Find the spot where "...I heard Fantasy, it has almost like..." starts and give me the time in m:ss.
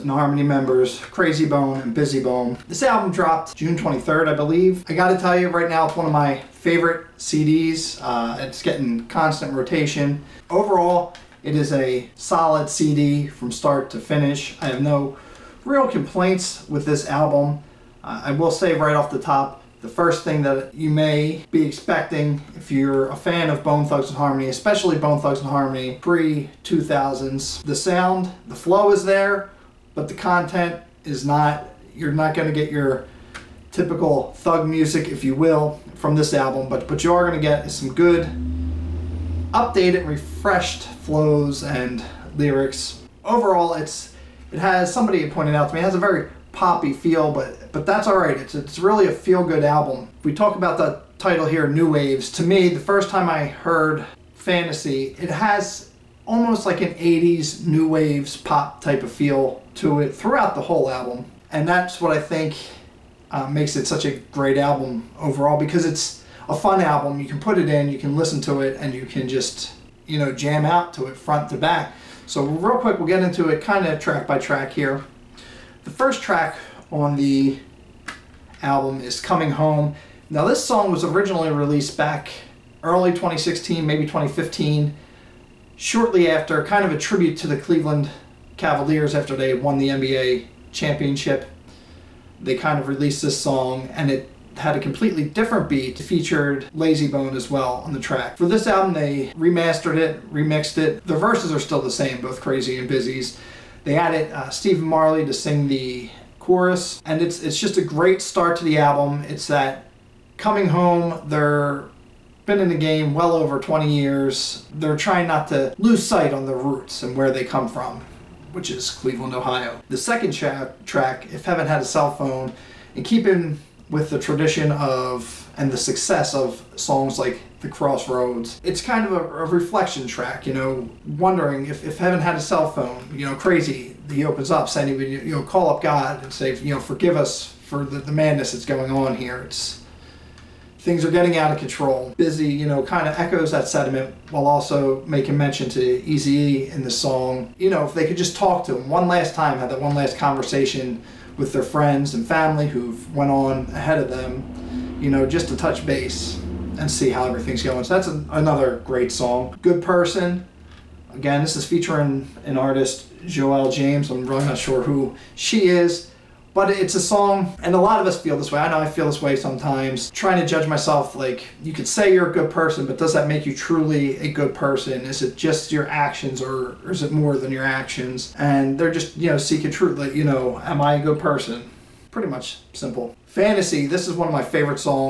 0:53.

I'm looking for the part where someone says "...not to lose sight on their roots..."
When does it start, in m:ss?
1:55.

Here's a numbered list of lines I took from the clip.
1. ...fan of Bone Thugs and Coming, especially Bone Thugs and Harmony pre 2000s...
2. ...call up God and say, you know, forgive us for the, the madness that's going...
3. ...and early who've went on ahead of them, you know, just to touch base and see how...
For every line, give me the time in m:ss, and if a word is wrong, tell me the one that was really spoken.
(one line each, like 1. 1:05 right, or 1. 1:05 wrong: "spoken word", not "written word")
1. 0:23 wrong: "Harmony", not "Coming"
2. 2:15 right
3. 2:32 wrong: "family", not "early".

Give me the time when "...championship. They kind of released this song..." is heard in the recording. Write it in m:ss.
1:30.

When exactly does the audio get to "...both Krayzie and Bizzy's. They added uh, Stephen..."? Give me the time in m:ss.
1:42.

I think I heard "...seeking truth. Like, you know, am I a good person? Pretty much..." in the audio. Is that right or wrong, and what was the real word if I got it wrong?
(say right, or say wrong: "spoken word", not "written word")
right.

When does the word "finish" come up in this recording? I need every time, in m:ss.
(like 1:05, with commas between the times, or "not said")
0:13.